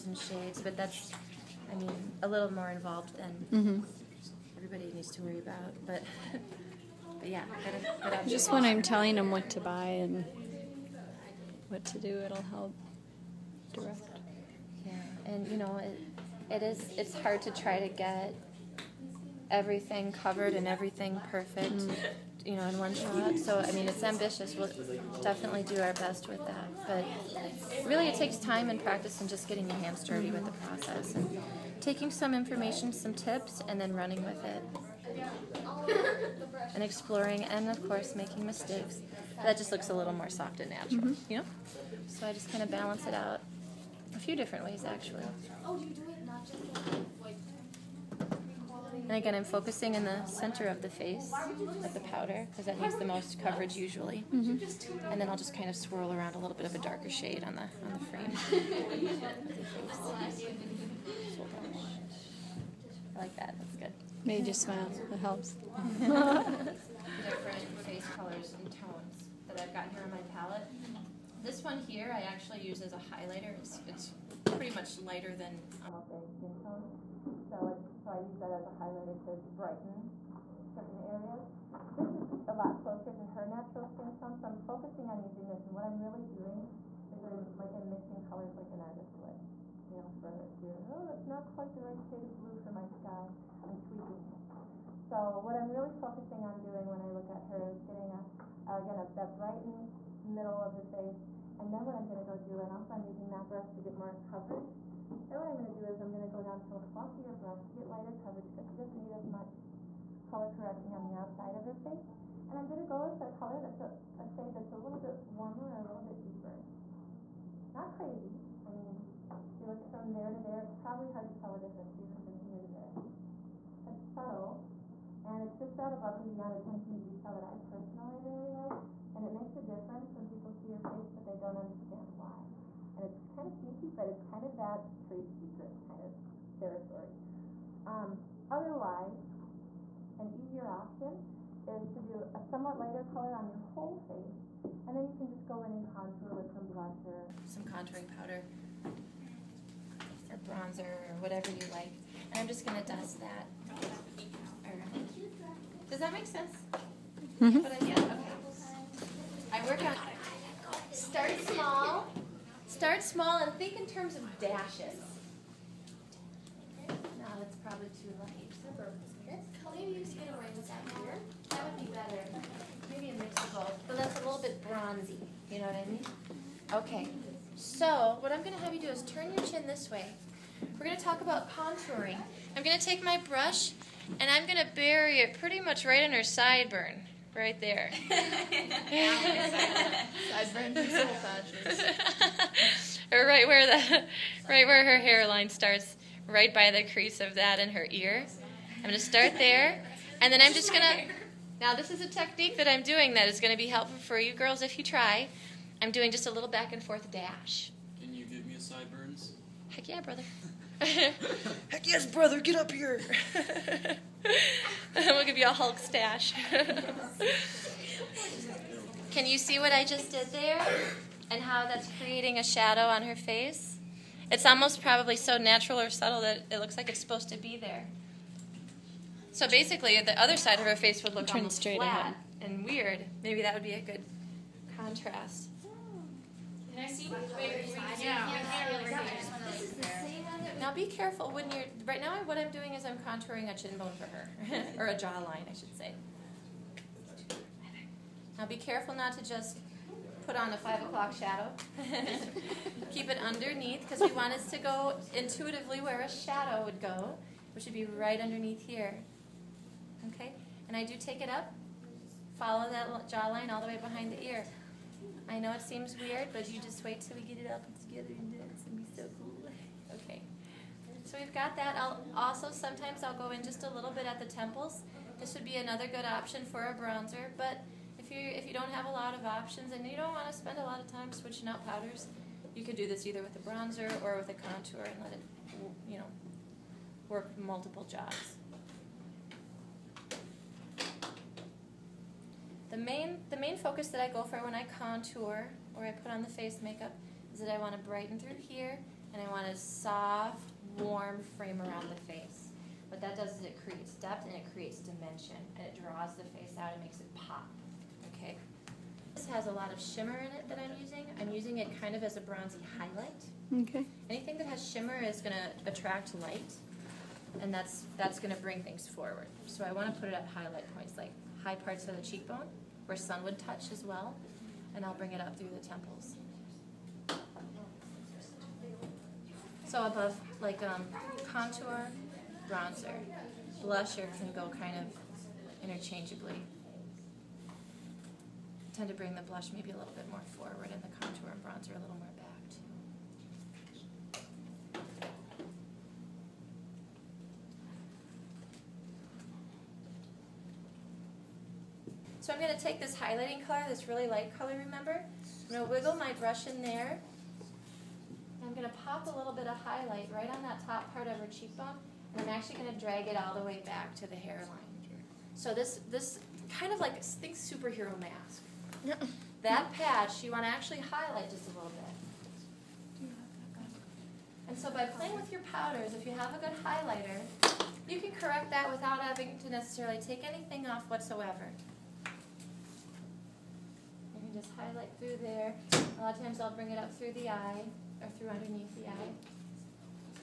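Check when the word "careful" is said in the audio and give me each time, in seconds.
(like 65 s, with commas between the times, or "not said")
240 s, 248 s.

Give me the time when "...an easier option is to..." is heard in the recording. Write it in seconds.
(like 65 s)
140 s.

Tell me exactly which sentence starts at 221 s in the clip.
And how that's creating a shadow on her face?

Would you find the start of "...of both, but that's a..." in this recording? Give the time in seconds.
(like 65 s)
173 s.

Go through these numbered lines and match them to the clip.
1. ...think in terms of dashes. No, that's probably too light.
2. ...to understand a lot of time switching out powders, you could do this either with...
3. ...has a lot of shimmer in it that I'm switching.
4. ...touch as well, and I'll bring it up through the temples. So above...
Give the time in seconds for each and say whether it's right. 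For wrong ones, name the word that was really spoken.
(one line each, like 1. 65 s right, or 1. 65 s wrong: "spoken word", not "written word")
1. 163 s right
2. 280 s wrong: "spend", not "understand"
3. 309 s wrong: "using", not "switching"
4. 323 s right.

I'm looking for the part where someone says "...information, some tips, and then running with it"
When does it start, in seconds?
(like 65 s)
32 s.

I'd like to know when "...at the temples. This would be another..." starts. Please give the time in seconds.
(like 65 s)
274 s.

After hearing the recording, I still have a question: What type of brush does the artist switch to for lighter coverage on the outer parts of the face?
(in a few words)
fluffier brush.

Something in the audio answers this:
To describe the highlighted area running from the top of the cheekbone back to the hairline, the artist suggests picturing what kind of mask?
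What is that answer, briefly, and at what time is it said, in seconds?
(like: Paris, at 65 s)
superhero mask, at 367 s.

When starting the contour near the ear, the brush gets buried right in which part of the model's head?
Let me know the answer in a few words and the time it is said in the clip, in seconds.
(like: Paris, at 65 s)
sideburn, at 186 s.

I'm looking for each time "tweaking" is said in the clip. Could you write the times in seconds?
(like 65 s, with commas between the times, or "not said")
93 s.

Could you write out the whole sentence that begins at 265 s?
I know it seems weird, but you just wait till we get it up and together and do it.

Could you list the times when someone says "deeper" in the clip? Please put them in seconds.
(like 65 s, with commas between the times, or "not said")
116 s.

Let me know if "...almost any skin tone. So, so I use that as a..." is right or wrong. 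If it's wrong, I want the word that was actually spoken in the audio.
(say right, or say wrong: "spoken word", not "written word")
right.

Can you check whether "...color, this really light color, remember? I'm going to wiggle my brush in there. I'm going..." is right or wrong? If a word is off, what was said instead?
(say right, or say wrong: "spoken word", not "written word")
right.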